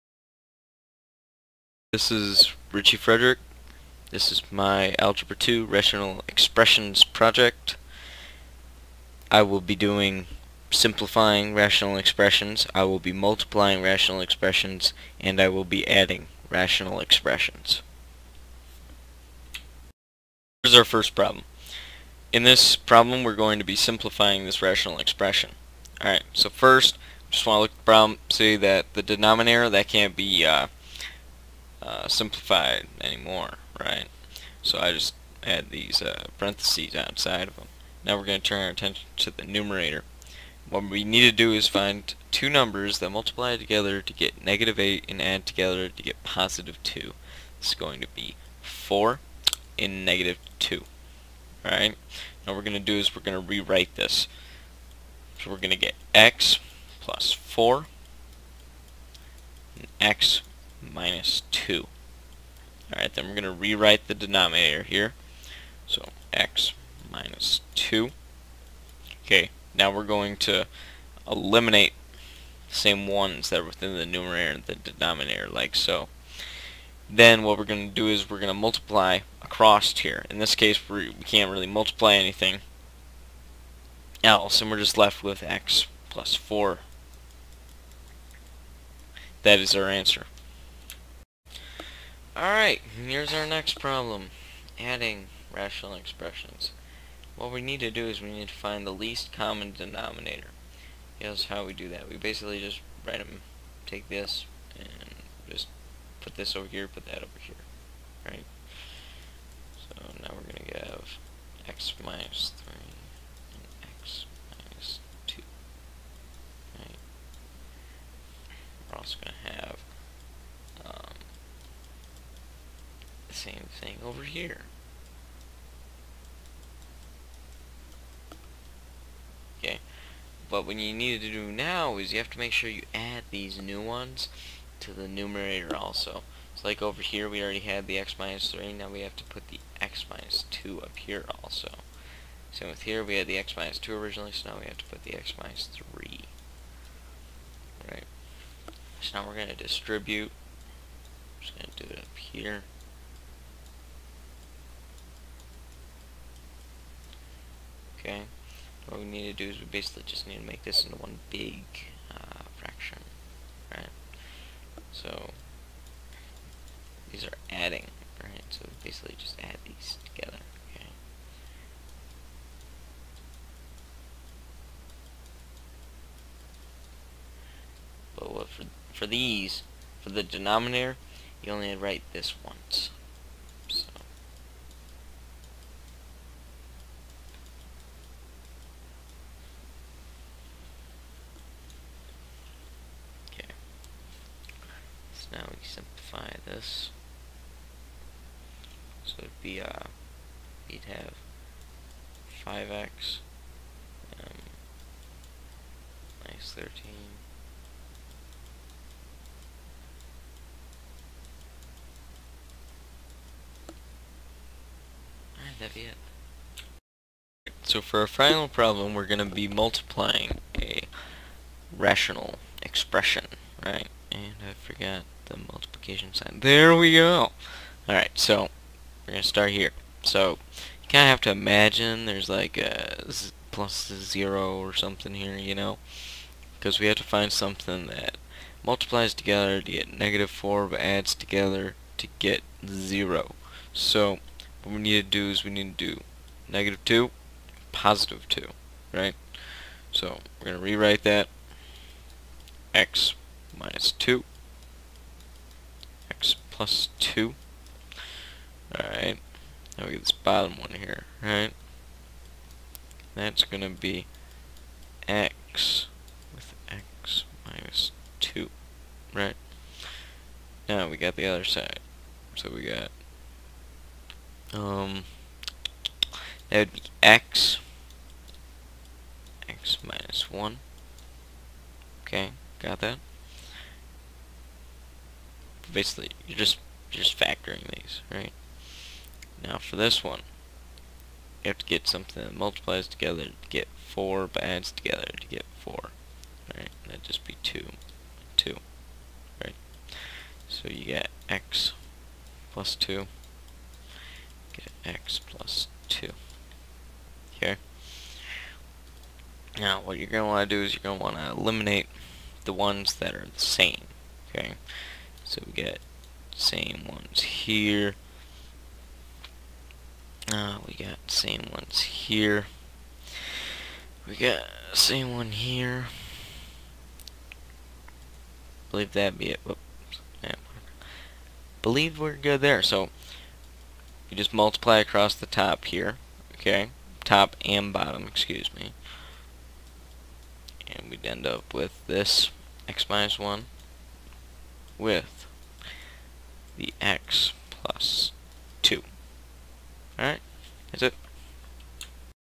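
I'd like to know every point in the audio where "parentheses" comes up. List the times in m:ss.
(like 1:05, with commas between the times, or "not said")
0:36.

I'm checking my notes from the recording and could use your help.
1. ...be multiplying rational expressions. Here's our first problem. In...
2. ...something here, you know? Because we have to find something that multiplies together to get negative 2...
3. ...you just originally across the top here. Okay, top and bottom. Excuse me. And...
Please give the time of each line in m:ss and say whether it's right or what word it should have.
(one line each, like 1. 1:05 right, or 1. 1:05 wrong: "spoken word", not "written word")
1. 0:15 wrong: "adding", not "multiplying"
2. 3:54 wrong: "4", not "2"
3. 5:34 wrong: "multiply", not "originally".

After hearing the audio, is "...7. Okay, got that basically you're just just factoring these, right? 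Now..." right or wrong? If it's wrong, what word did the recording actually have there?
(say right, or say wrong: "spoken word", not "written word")
wrong: "1", not "7".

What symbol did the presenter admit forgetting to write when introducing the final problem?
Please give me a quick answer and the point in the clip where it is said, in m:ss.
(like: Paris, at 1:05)
multiplication sign, at 3:45.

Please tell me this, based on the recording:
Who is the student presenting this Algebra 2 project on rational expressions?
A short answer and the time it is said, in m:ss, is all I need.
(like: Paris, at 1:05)
Richie Frederick, at 0:02.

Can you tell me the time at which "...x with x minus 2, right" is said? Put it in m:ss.
4:25.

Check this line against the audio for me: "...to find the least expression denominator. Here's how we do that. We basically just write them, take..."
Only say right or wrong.
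wrong.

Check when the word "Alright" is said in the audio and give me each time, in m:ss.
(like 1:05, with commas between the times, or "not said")
0:26, 0:51, 1:02, 1:32, 3:35, 3:47, 4:18, 5:49.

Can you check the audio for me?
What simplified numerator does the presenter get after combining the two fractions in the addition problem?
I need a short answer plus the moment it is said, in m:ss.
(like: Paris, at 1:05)
5x - 13, at 3:22.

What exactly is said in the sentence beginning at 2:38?
Okay, what we need to do is we basically just need to make this into one big uh, fraction, right?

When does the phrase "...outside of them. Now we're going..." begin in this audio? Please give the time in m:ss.
0:36.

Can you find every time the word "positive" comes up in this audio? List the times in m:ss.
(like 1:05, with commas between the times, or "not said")
0:46, 4:07.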